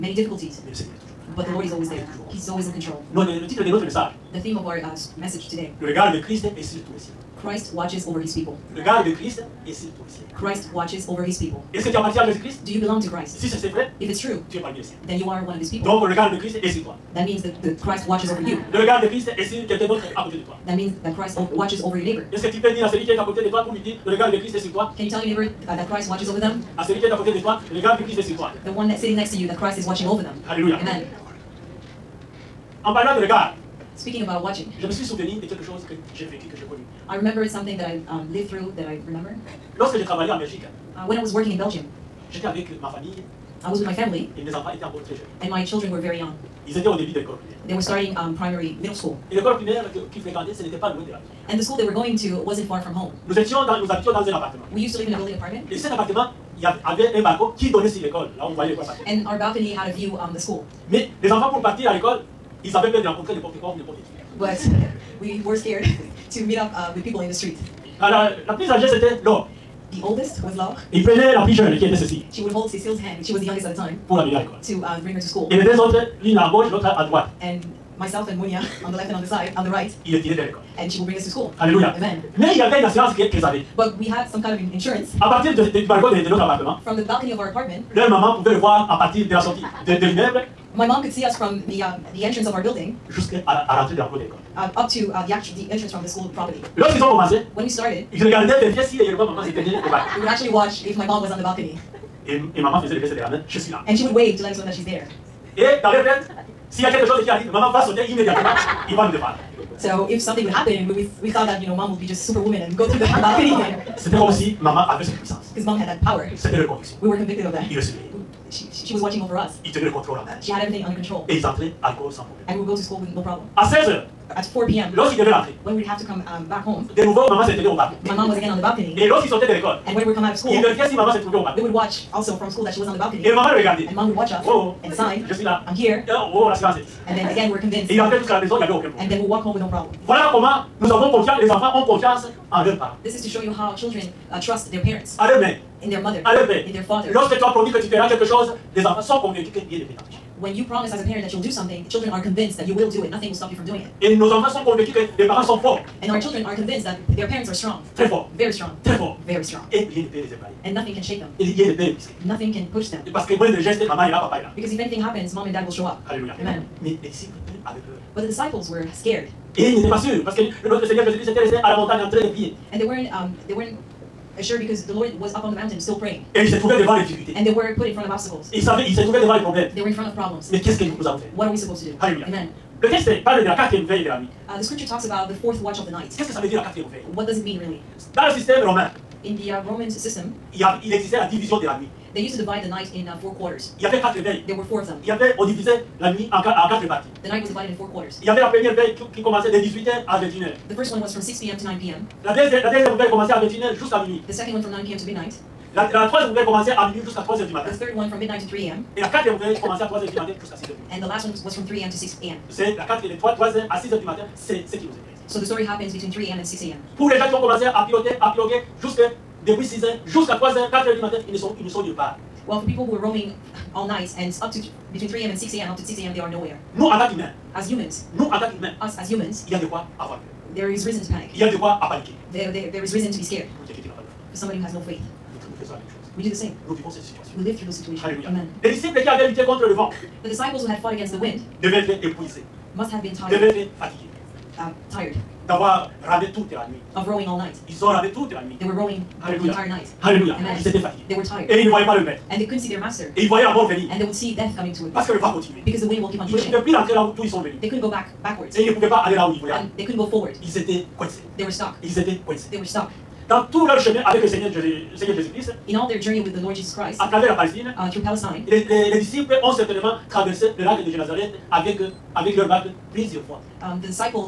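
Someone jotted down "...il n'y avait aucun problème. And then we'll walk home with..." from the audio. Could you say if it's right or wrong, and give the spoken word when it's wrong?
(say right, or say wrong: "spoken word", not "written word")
right.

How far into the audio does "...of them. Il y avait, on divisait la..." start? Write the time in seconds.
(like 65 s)
194 s.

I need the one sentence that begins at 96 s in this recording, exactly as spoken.
ont commencé, when we started, We would actually watch if my mom was on the balcony.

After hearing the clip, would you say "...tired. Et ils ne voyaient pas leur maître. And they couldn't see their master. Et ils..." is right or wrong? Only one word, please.
right.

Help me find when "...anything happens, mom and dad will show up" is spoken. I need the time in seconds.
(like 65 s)
164 s.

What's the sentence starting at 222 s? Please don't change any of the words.
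Well, for people who are roaming all night and up to between 3 a.m.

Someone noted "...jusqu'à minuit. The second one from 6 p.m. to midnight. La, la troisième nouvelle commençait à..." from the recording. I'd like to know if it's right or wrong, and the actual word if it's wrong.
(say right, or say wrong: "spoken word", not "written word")
wrong: "9", not "6".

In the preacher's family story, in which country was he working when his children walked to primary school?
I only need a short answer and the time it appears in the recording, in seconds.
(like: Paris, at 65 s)
Belgium, at 41 s.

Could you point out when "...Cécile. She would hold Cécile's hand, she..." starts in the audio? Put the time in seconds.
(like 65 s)
71 s.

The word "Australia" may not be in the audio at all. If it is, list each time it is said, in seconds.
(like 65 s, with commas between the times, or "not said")
not said.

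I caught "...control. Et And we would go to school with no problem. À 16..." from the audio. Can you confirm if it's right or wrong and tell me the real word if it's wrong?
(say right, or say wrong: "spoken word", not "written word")
right.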